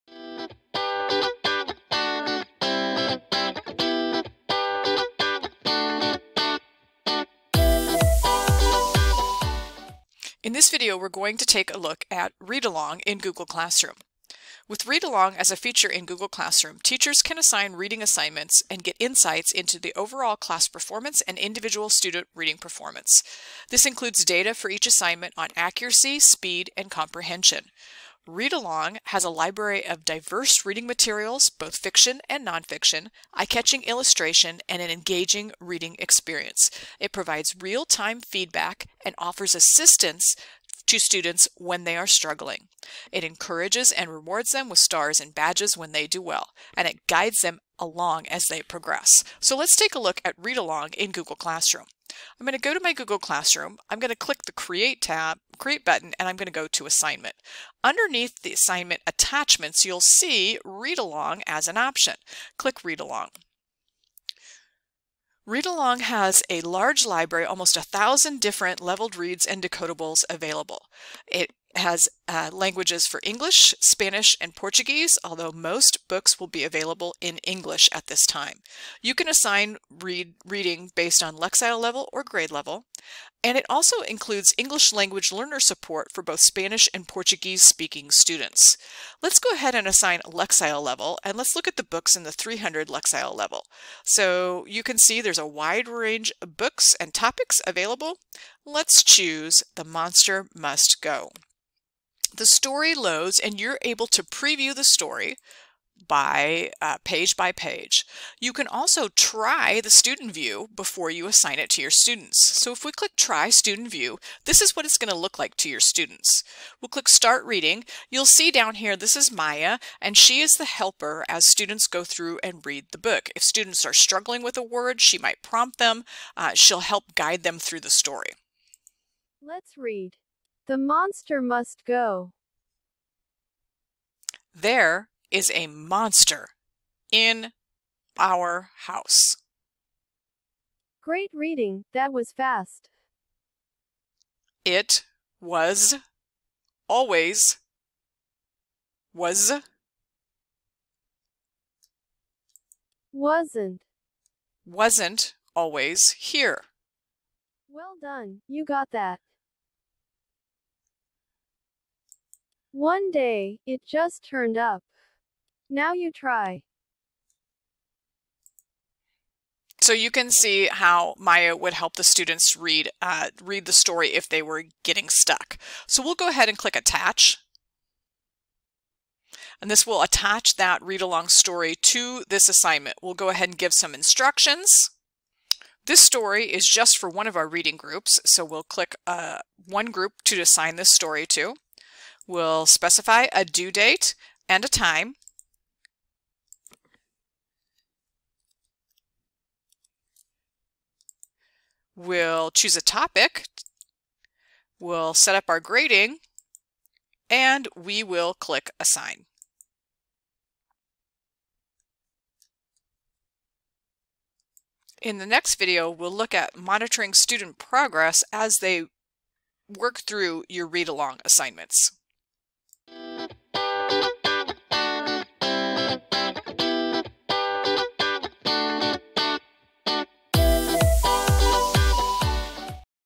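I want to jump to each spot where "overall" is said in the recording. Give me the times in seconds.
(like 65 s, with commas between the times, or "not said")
19 s.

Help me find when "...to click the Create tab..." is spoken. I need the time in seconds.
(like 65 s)
54 s.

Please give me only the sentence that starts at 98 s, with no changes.
Let's choose The Monster Must Go the story loads and you're able to preview the story by uh, page by page.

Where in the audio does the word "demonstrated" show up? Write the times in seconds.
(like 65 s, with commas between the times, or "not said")
not said.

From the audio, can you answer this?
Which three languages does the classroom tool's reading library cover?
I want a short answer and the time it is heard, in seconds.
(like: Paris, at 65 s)
English, Spanish, and Portuguese, at 73 s.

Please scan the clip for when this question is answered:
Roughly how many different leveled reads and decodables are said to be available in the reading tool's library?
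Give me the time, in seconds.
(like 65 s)
67 s.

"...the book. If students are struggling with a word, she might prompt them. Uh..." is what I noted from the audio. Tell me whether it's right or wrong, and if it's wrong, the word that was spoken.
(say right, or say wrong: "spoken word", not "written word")
right.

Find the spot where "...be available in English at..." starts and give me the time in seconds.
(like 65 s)
76 s.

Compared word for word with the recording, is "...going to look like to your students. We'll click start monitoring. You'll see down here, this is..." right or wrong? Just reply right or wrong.
wrong.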